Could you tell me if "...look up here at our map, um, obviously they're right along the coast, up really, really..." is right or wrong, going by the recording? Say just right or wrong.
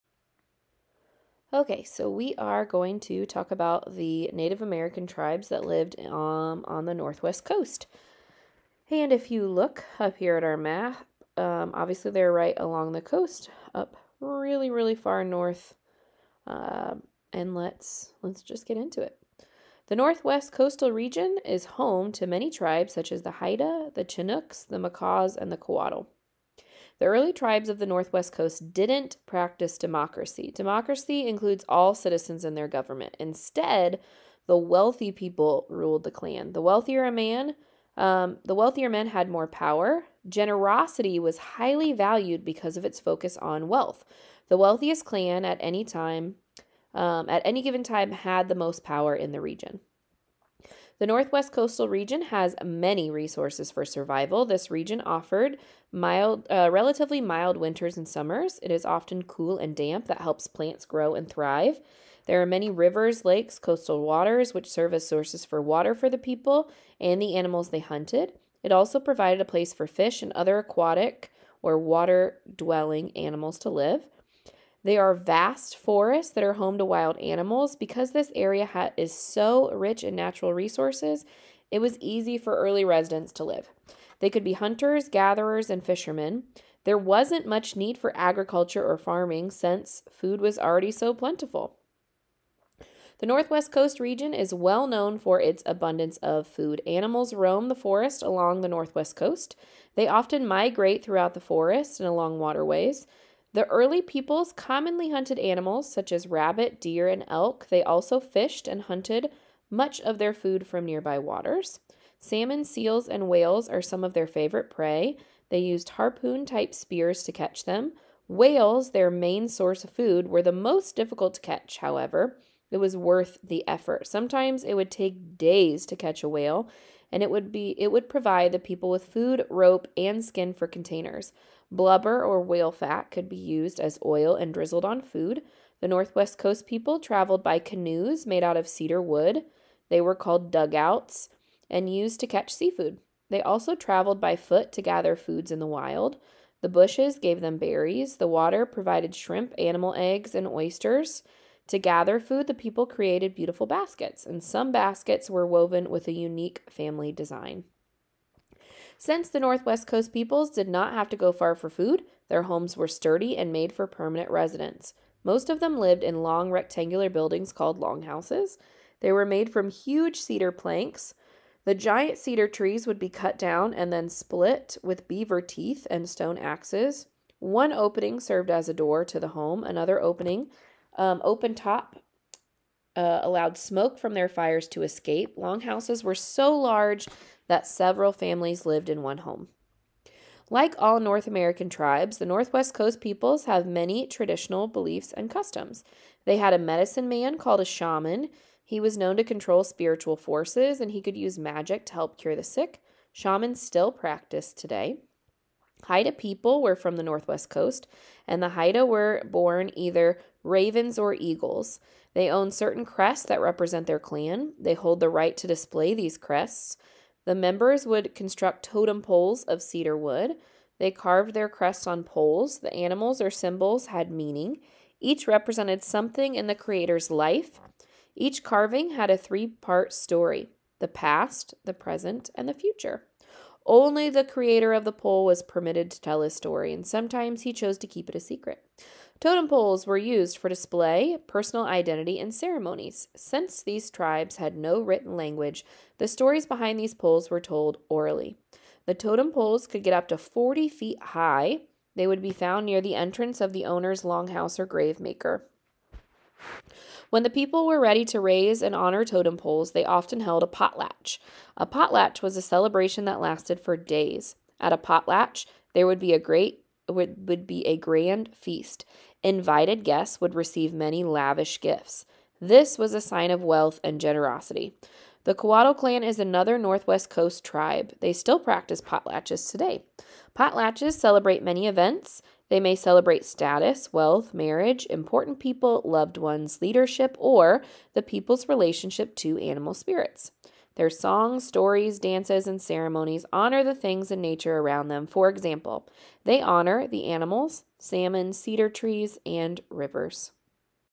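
right.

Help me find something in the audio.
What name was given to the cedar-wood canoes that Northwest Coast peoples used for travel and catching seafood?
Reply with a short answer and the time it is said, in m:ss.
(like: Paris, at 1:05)
Dugouts, at 2:20.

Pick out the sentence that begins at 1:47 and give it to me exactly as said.
They also fished and hunted much of their food from nearby waters.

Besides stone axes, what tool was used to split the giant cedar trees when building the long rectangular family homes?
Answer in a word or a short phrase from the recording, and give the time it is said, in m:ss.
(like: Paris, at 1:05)
Beaver teeth, at 2:55.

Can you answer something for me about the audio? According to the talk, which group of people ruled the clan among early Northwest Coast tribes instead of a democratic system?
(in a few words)
The wealthy people.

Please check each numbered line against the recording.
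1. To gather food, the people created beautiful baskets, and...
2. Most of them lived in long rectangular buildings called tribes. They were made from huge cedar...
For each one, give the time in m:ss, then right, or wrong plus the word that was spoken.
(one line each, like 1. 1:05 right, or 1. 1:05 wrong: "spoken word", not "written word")
1. 2:31 right
2. 2:45 wrong: "longhouses", not "tribes".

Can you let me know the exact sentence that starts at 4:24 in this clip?
At a potlatch, there would be a great would, would be a grand feast.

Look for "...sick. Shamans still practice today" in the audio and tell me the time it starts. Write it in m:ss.
3:22.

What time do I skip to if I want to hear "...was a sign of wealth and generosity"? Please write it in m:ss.
4:32.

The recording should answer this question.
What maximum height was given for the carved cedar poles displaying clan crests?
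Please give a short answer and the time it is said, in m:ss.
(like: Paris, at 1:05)
40 feet, at 4:10.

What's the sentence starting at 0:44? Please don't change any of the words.
The wealthiest clan at any time, um, at any given time, had the most power in the region.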